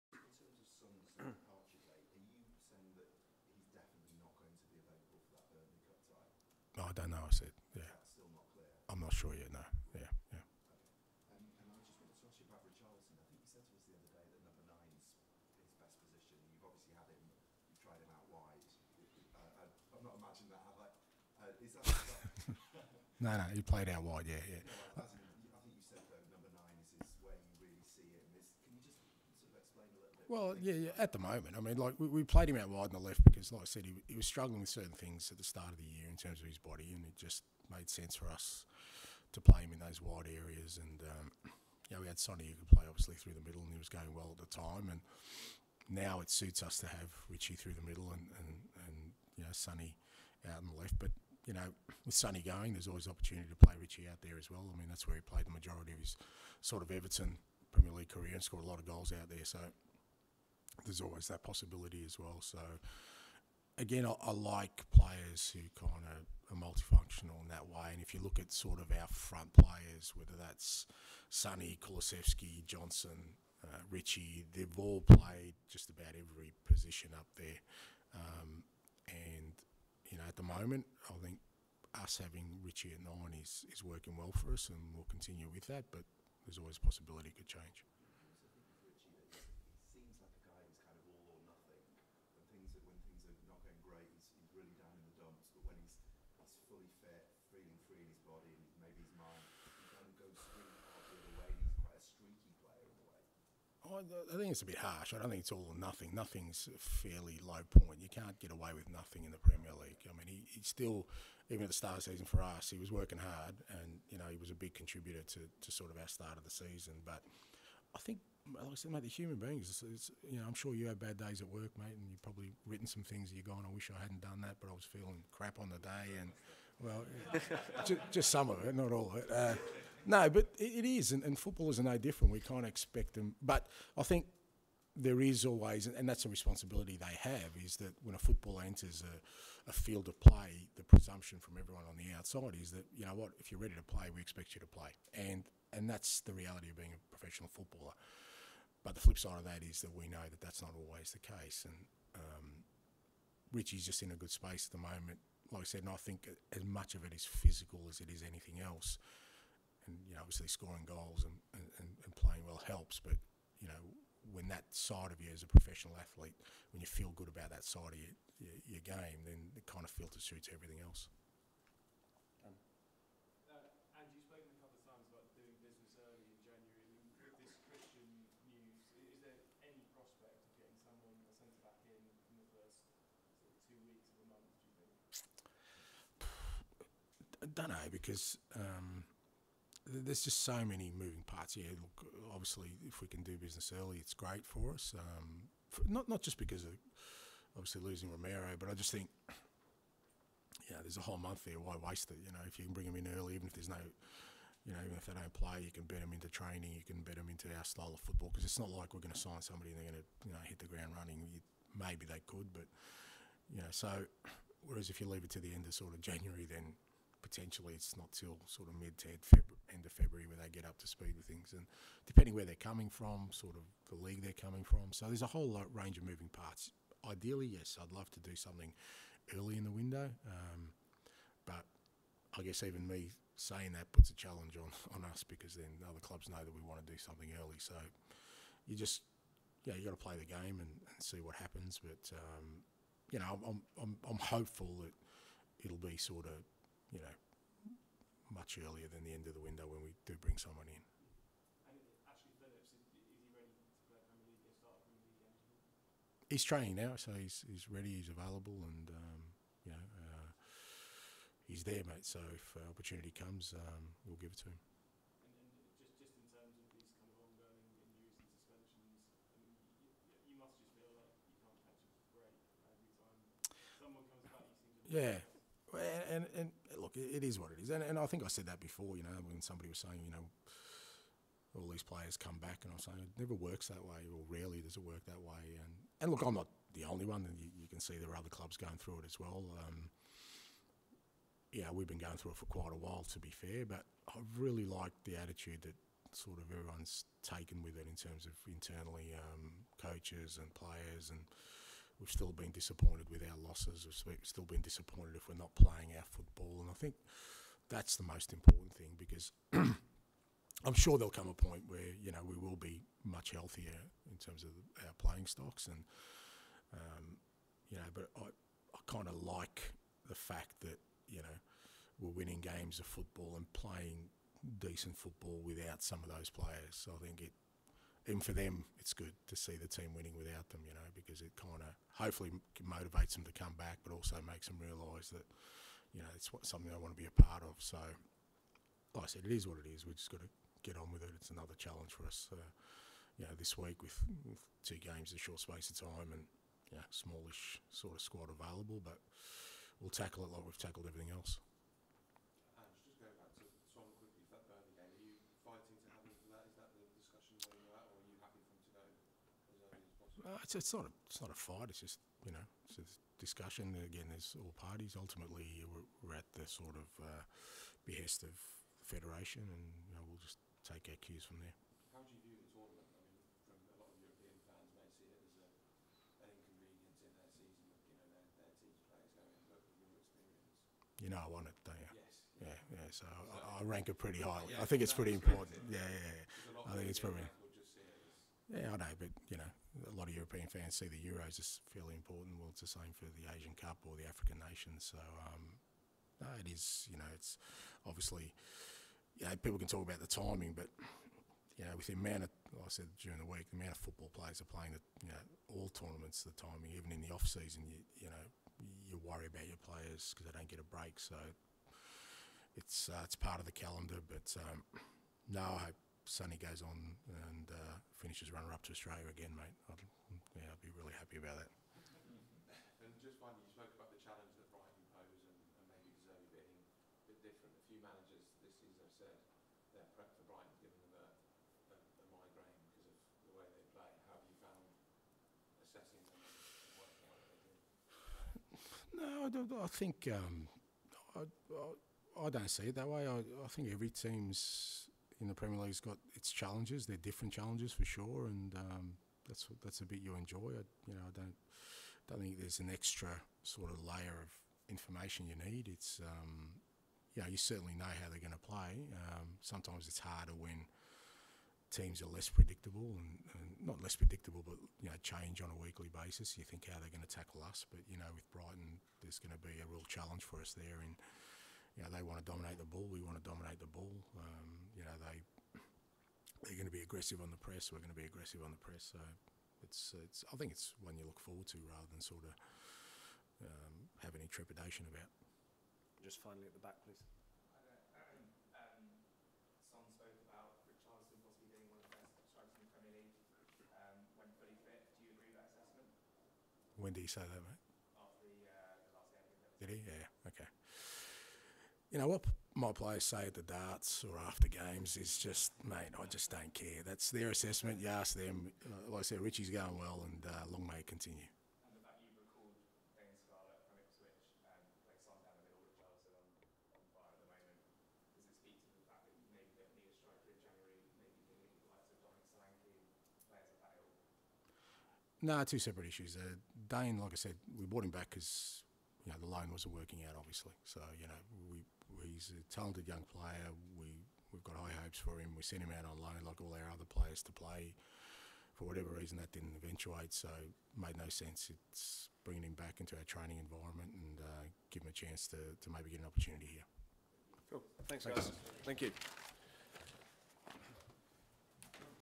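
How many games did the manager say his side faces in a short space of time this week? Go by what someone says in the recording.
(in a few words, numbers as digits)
2.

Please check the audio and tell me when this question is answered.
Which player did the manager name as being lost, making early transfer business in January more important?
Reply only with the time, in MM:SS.
03:18.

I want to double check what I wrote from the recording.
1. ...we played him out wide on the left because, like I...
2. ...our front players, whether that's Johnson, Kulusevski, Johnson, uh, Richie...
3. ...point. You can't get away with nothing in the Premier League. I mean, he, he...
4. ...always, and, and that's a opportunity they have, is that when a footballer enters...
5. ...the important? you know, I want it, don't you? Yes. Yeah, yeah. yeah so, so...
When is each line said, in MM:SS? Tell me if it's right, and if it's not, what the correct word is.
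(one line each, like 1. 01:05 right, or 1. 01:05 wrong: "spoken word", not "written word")
1. 00:32 right
2. 01:08 wrong: "Sonny", not "Johnson"
3. 01:47 right
4. 02:15 wrong: "responsibility", not "opportunity"
5. 06:12 wrong: "tournament", not "important".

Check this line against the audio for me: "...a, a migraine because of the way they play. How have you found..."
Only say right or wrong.
right.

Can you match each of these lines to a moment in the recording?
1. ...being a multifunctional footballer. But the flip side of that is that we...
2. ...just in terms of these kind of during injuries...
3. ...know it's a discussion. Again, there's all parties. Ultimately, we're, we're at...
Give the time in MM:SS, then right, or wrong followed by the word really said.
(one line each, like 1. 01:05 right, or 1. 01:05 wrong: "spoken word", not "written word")
1. 02:26 wrong: "professional", not "multifunctional"
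2. 04:25 wrong: "ongoing", not "during"
3. 06:02 right.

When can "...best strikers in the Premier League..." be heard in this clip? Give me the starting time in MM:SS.
08:11.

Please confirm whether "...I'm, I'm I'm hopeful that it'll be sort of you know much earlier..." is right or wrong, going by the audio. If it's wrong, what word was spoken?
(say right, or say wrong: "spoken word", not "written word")
right.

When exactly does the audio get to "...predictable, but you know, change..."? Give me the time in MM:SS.
07:43.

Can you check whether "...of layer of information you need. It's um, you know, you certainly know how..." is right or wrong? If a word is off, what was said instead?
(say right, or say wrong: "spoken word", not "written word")
right.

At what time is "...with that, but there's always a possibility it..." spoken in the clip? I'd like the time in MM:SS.
01:25.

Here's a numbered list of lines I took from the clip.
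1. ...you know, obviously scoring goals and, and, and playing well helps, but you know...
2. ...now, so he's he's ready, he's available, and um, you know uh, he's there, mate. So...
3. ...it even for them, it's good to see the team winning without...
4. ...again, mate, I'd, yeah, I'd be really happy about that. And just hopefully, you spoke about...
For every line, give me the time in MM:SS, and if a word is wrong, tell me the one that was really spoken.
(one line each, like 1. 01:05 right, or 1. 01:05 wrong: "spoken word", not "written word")
1. 02:40 right
2. 04:16 right
3. 05:27 right
4. 06:59 wrong: "finally", not "hopefully".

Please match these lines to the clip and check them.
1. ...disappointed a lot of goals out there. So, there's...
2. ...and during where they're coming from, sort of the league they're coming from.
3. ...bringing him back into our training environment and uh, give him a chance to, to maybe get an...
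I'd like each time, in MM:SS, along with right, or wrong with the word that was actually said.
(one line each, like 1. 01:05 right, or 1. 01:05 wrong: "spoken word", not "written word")
1. 00:58 wrong: "scored", not "disappointed"
2. 03:41 wrong: "depending", not "during"
3. 09:02 right.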